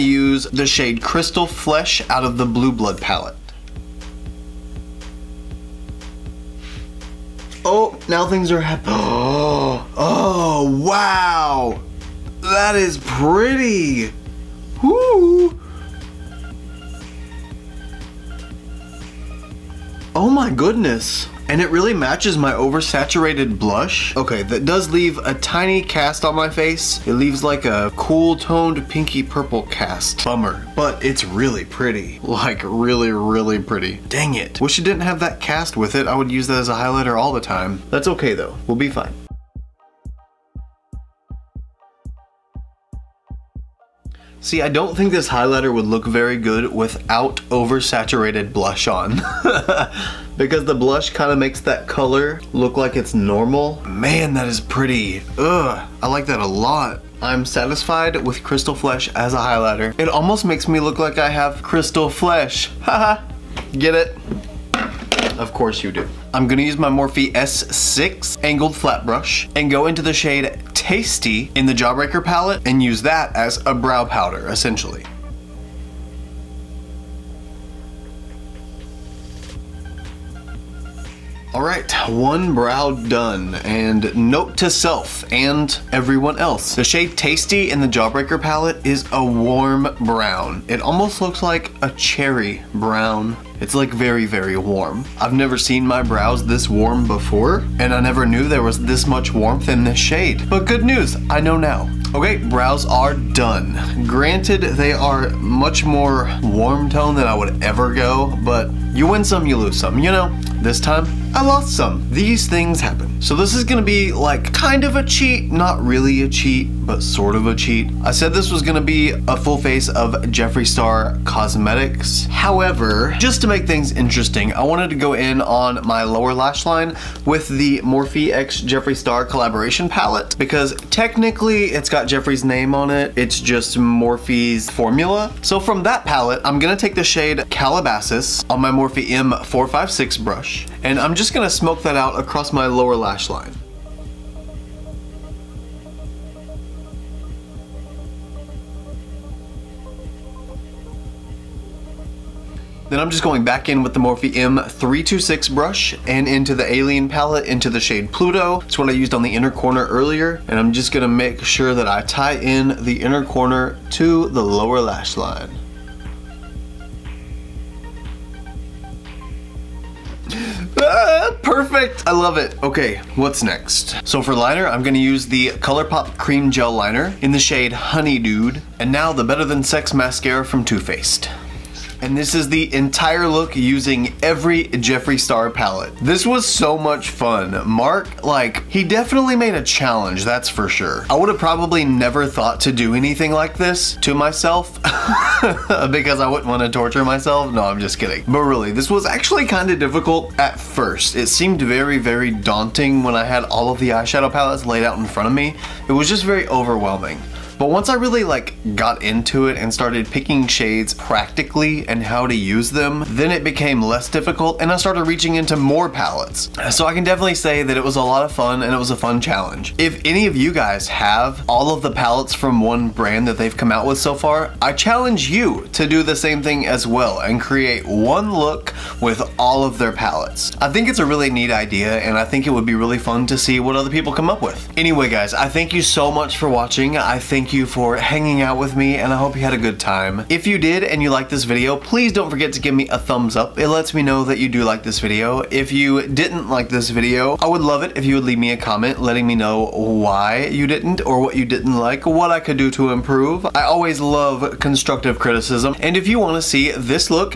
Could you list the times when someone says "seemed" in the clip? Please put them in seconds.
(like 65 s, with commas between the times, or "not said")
201 s.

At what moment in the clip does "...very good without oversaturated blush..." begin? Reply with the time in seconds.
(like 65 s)
46 s.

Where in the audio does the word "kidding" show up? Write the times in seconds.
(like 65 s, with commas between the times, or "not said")
197 s.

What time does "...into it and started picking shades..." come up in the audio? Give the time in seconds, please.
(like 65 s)
209 s.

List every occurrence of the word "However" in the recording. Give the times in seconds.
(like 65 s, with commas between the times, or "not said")
122 s.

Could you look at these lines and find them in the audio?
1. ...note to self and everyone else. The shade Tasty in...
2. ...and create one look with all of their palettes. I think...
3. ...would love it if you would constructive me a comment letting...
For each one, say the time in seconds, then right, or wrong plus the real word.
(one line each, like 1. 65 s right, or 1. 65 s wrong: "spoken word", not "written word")
1. 84 s right
2. 227 s right
3. 247 s wrong: "leave", not "constructive".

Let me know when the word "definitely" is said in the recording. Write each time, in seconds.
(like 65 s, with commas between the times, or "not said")
188 s, 217 s.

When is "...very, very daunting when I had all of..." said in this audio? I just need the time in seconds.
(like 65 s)
201 s.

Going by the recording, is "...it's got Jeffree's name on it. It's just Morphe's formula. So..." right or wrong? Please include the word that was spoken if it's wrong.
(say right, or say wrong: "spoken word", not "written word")
right.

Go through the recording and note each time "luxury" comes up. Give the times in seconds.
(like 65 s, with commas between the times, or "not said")
not said.